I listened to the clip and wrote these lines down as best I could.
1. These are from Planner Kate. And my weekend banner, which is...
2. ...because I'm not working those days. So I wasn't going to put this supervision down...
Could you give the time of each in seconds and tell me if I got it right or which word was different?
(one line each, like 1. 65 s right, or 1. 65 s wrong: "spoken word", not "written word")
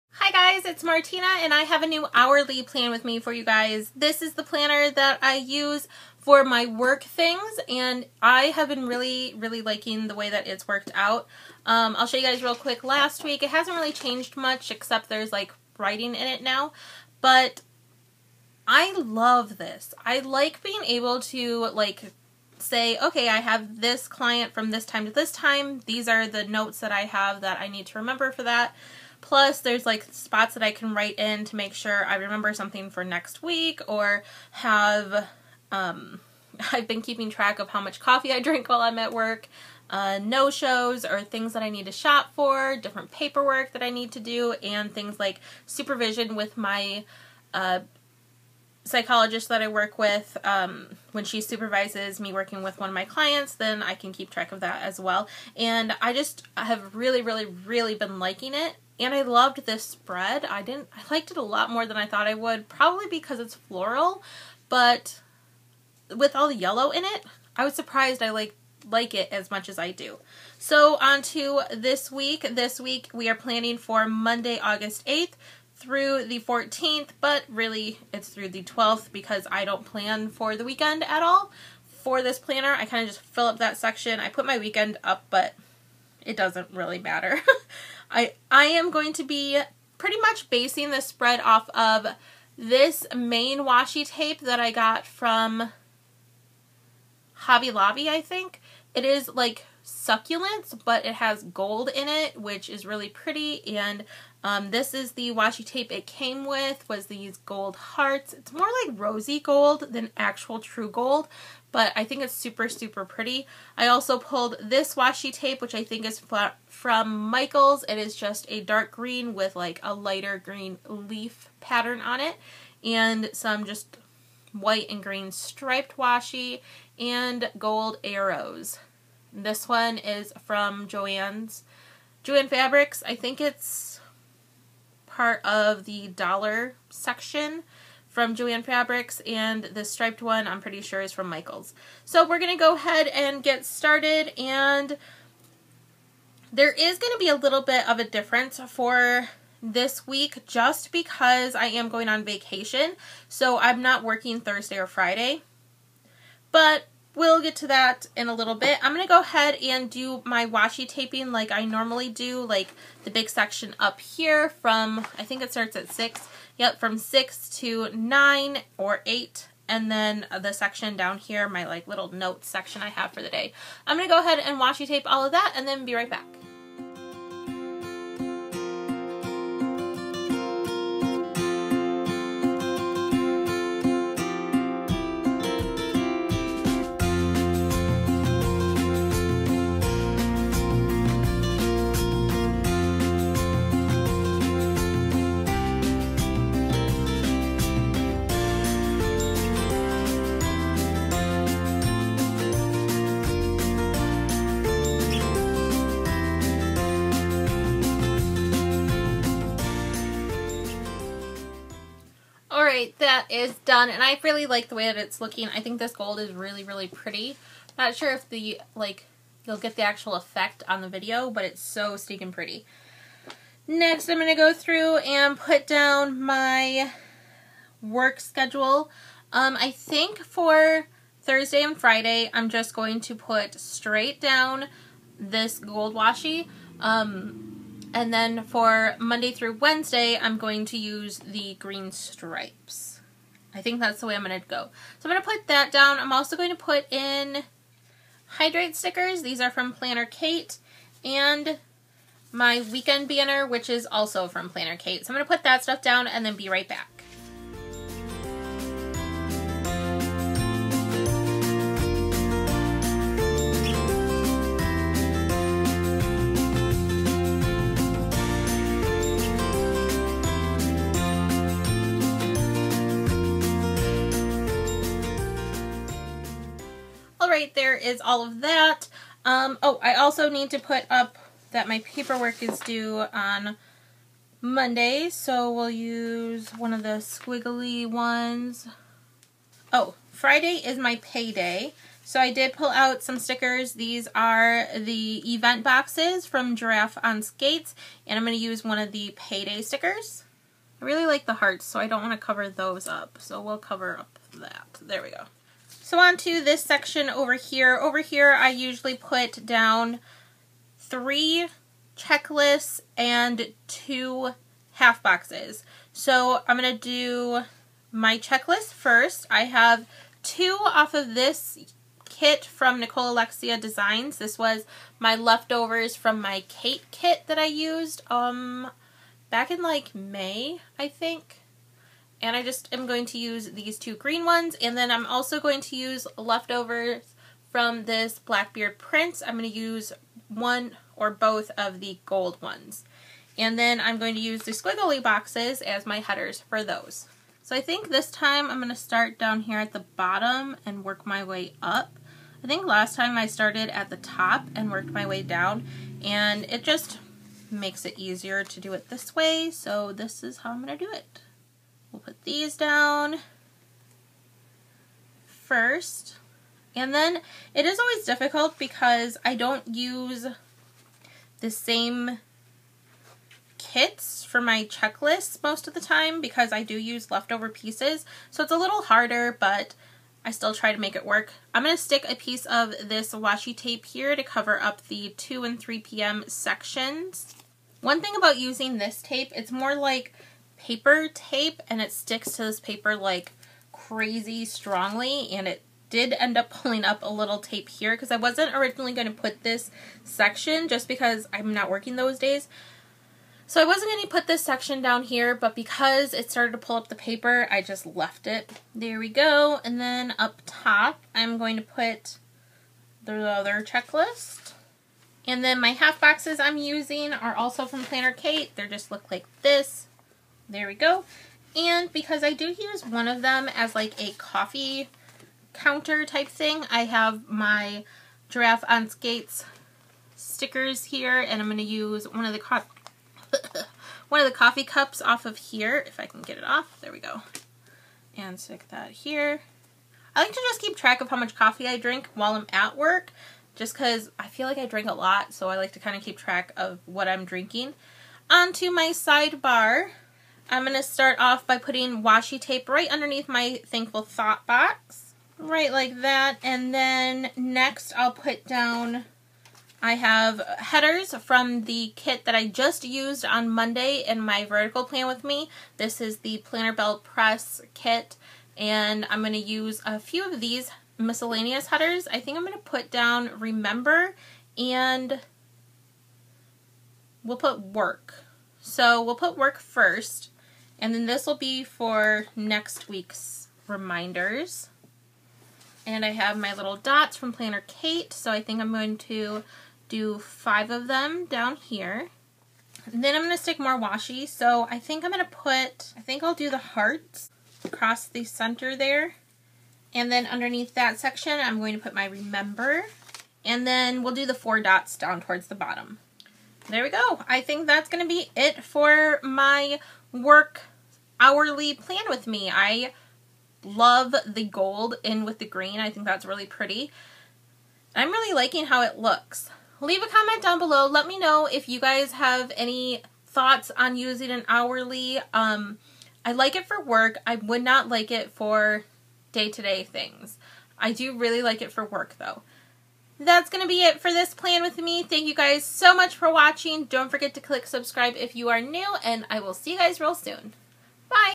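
1. 249 s right
2. 400 s wrong: "section", not "supervision".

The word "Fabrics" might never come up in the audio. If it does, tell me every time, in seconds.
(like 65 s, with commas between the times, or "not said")
132 s, 138 s.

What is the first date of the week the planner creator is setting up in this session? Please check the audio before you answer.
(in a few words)
Monday, August 8th.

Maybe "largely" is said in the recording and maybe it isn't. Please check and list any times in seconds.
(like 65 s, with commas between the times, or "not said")
not said.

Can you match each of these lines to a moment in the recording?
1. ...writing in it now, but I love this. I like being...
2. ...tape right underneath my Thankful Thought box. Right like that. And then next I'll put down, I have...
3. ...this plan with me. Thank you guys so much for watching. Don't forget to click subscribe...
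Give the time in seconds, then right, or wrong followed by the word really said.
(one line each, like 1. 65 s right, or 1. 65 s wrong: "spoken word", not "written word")
1. 15 s right
2. 452 s right
3. 534 s right.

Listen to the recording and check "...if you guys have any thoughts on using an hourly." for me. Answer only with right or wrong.
right.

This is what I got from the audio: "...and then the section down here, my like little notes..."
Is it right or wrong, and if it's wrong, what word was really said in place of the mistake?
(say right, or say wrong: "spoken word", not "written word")
right.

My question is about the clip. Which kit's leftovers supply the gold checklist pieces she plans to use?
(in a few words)
Blackbeard Prince.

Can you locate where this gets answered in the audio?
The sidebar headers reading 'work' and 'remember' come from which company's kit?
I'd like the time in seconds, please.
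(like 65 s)
466 s.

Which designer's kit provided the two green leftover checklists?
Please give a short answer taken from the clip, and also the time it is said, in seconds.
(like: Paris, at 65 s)
Nicole Alexia Designs, at 322 s.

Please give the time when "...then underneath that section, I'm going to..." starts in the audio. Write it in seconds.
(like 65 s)
500 s.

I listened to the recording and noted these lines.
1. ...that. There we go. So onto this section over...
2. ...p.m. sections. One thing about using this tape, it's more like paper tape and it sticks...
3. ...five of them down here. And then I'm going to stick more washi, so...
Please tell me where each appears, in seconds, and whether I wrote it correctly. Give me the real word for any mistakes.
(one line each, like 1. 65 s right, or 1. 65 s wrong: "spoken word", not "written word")
1. 304 s right
2. 385 s right
3. 490 s right.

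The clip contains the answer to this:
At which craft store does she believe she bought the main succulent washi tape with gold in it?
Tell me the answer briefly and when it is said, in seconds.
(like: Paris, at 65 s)
Hobby Lobby, at 97 s.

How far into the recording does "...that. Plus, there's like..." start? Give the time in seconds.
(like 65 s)
28 s.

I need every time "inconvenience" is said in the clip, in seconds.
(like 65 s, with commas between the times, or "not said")
not said.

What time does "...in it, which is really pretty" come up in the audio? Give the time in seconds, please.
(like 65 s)
101 s.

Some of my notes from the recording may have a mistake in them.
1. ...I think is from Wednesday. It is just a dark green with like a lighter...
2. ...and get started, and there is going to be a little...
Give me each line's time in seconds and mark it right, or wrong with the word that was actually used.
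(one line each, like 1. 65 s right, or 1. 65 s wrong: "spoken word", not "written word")
1. 115 s wrong: "Michaels", not "Wednesday"
2. 143 s right.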